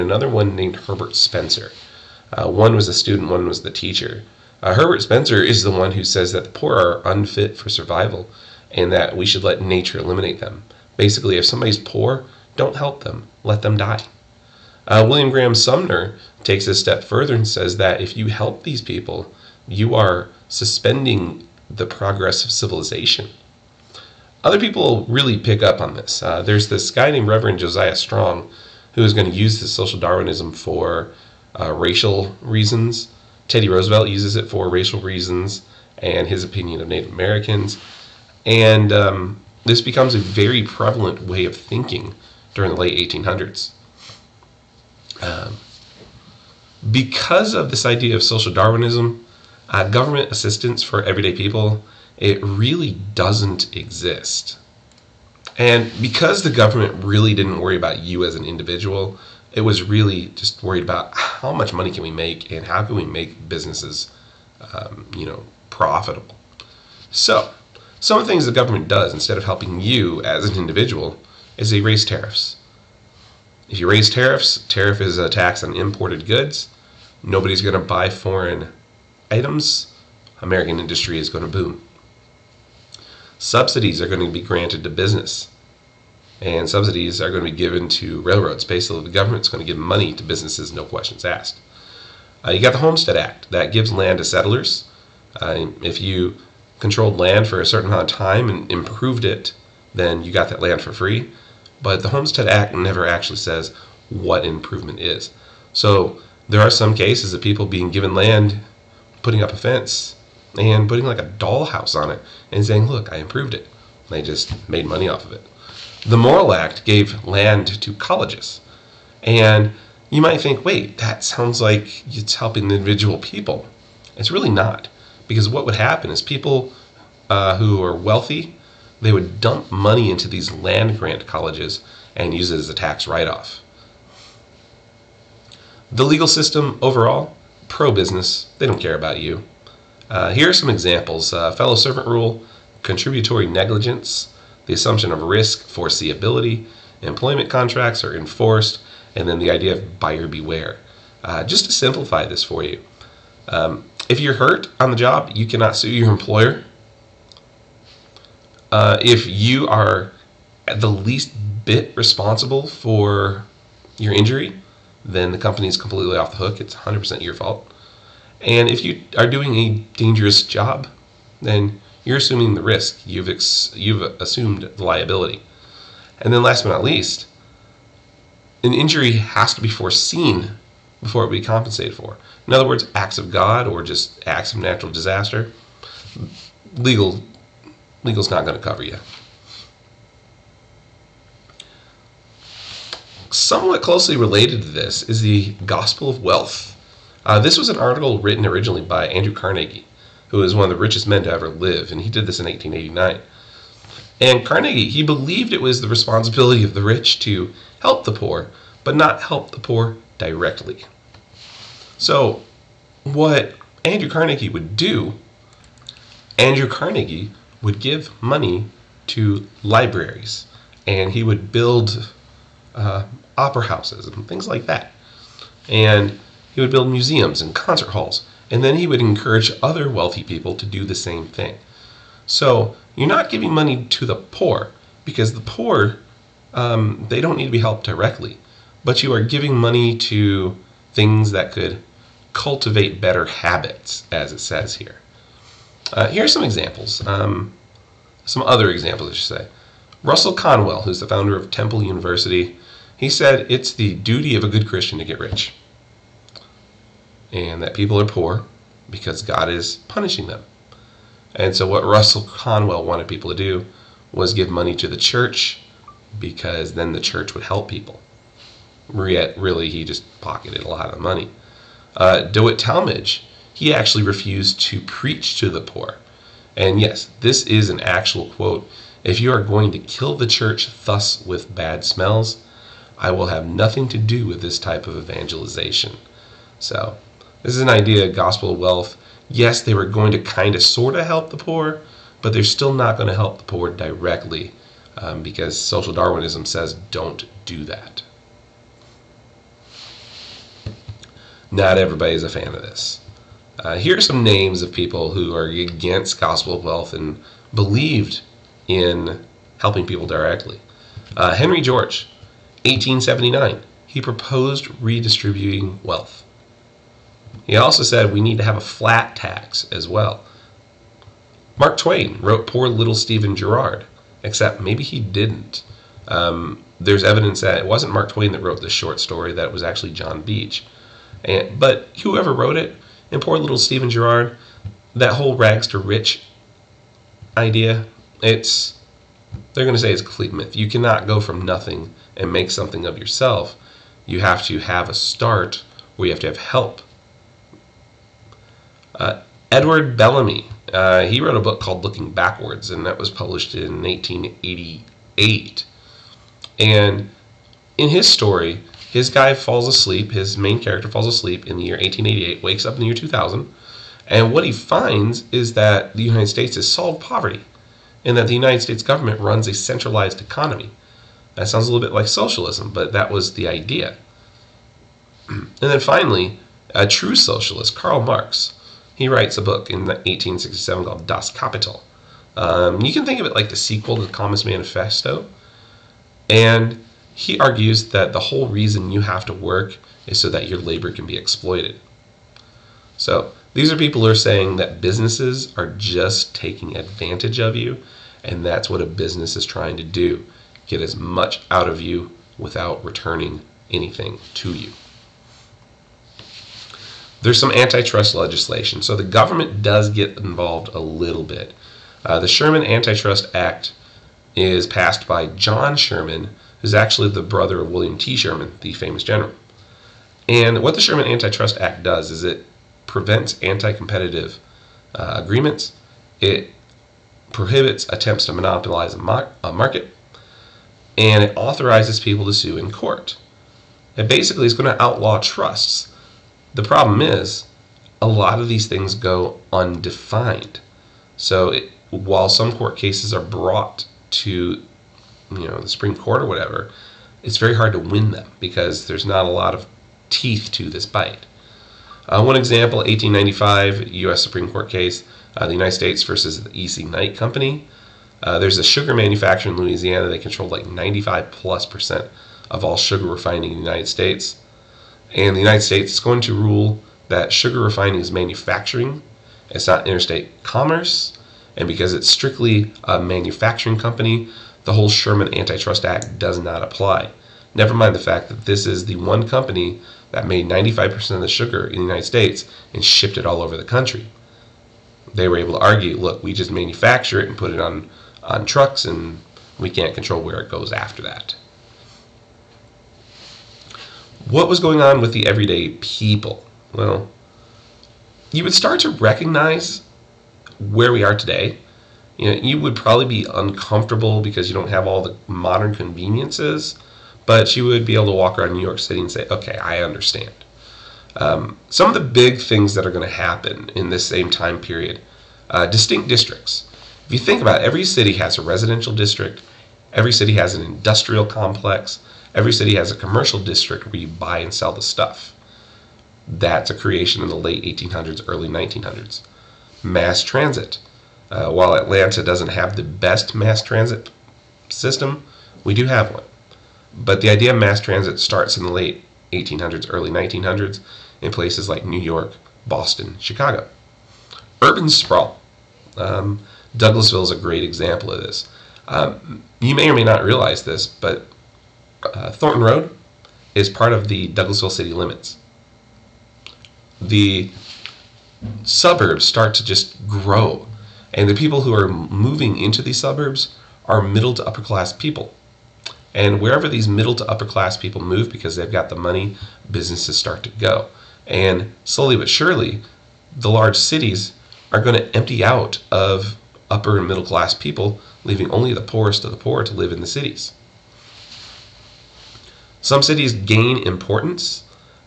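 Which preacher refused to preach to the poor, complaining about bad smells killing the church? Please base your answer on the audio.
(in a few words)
DeWitt Talmage.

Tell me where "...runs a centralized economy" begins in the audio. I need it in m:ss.
6:09.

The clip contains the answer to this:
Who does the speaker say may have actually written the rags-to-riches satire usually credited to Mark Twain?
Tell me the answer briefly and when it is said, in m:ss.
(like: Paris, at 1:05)
John Beach, at 5:29.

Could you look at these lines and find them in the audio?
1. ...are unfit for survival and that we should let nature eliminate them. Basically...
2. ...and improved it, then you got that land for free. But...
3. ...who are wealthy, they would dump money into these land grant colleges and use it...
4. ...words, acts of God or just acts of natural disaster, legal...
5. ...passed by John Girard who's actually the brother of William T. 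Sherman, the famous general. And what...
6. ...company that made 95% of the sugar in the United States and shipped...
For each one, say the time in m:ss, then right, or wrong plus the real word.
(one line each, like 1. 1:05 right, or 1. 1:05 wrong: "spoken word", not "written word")
1. 0:06 right
2. 1:38 right
3. 2:07 right
4. 3:02 right
5. 6:54 wrong: "Sherman", not "Girard"
6. 7:59 right.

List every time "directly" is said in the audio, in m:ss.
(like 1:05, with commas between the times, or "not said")
3:30, 3:57, 4:53, 5:10.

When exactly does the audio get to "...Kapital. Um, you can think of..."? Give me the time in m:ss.
6:21.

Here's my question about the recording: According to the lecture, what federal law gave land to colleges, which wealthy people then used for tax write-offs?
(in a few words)
Morrill Act.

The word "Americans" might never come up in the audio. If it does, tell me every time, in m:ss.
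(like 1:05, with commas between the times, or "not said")
0:37, 1:20.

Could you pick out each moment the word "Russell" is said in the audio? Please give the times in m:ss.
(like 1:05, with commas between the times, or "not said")
4:10, 4:21.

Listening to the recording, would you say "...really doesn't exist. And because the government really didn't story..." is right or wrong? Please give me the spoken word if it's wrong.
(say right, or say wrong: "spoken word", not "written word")
wrong: "worry", not "story".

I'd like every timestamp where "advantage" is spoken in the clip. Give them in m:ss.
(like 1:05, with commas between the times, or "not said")
6:36.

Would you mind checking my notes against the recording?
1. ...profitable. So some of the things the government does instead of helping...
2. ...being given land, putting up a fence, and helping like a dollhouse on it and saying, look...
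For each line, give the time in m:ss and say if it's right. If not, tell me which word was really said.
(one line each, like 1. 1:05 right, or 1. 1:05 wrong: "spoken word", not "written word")
1. 1:05 right
2. 1:47 wrong: "putting", not "helping".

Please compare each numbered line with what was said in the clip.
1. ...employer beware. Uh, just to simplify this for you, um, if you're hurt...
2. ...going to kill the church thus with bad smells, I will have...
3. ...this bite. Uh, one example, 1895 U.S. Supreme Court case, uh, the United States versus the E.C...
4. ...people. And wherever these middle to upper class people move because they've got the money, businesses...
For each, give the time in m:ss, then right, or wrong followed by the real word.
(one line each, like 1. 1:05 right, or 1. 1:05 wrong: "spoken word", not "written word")
1. 2:29 wrong: "buyer", not "employer"
2. 4:39 right
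3. 7:30 right
4. 9:24 right.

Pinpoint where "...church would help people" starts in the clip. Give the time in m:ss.
4:27.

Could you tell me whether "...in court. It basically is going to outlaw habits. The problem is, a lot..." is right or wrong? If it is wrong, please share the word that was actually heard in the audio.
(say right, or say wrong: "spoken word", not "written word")
wrong: "trusts", not "habits".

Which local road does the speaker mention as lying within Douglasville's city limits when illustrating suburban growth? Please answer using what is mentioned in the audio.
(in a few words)
Thornton Road.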